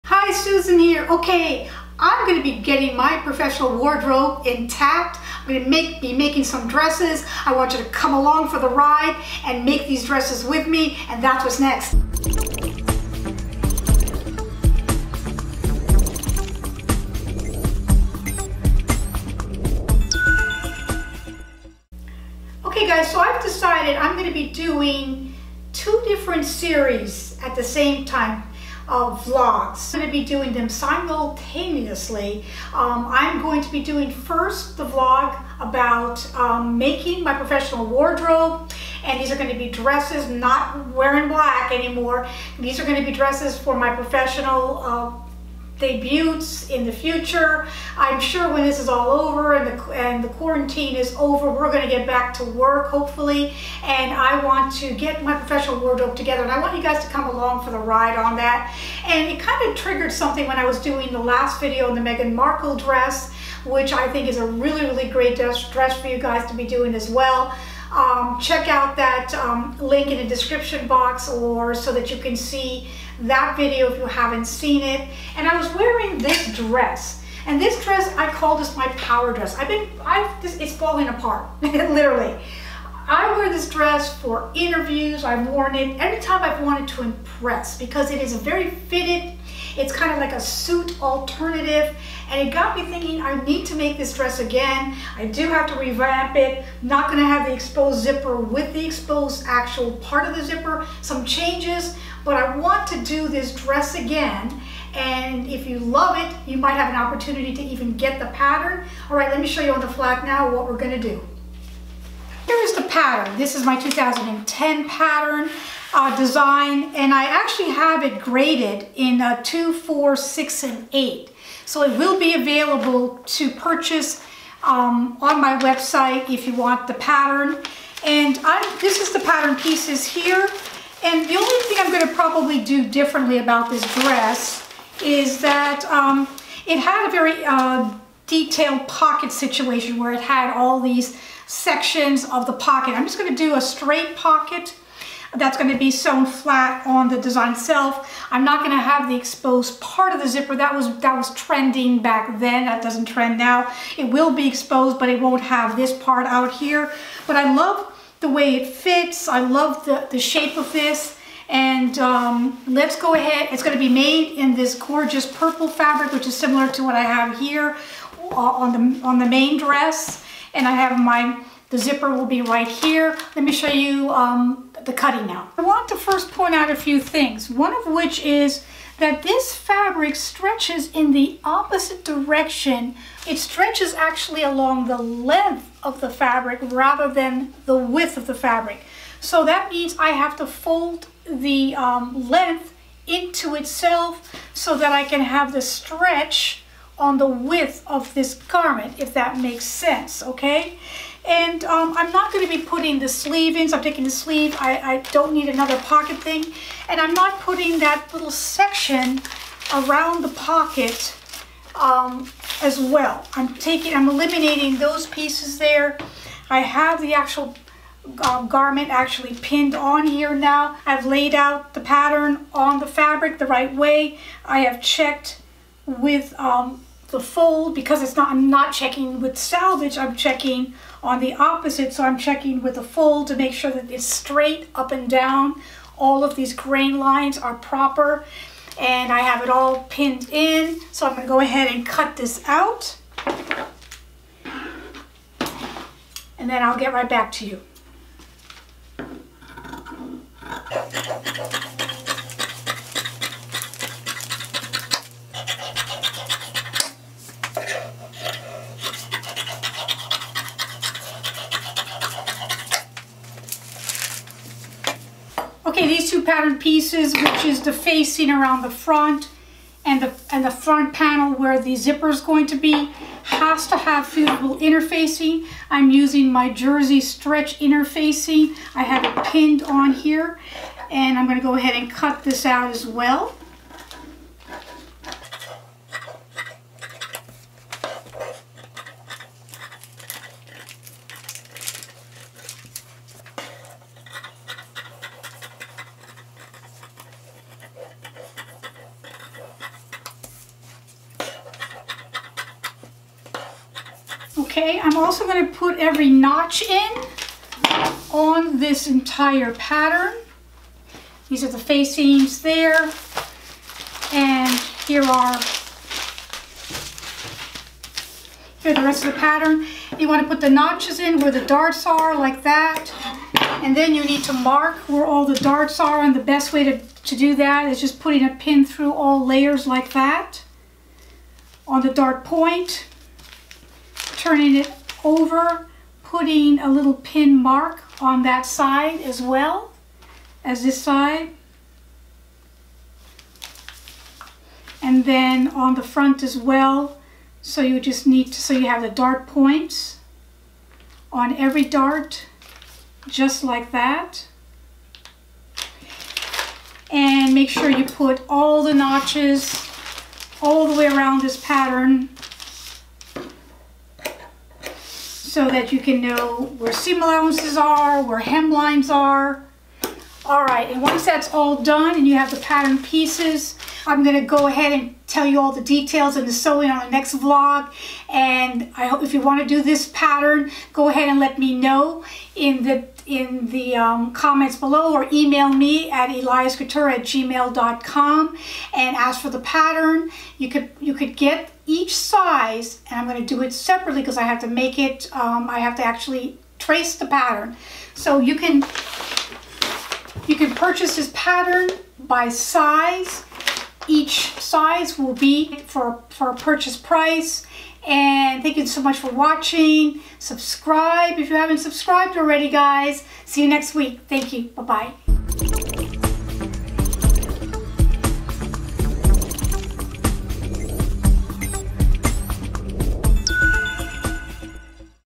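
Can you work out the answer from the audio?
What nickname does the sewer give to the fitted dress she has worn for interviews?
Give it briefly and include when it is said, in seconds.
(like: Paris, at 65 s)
power dress, at 78 s.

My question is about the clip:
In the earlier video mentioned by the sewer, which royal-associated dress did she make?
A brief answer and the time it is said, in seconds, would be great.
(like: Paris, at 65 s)
Meghan Markle dress, at 62 s.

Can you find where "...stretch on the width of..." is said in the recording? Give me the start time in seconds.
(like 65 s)
195 s.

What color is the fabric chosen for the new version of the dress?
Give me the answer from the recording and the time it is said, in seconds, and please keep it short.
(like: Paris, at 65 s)
purple, at 165 s.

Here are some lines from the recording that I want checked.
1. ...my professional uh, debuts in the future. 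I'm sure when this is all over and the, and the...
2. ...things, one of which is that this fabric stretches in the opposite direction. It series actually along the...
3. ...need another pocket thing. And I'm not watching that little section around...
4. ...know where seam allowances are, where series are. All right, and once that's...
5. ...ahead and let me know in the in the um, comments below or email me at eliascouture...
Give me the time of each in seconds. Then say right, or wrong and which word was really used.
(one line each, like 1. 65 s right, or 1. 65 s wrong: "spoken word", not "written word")
1. 43 s right
2. 176 s wrong: "stretches", not "series"
3. 205 s wrong: "putting", not "watching"
4. 366 s wrong: "hemlines", not "series"
5. 380 s right.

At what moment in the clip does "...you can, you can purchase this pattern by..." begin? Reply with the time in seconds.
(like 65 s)
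398 s.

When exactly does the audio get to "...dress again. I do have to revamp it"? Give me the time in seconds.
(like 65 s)
94 s.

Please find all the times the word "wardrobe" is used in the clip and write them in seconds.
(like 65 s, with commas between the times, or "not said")
3 s, 37 s, 55 s.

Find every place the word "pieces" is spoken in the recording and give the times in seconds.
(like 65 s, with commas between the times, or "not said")
129 s, 215 s, 266 s, 372 s.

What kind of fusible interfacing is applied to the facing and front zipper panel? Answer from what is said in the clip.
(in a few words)
jersey stretch interfacing.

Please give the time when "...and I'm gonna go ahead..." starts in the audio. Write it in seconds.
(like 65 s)
280 s.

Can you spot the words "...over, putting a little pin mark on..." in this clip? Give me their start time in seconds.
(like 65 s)
335 s.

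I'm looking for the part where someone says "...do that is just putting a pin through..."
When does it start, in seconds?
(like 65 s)
327 s.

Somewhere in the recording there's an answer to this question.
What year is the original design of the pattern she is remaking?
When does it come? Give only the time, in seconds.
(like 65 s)
113 s.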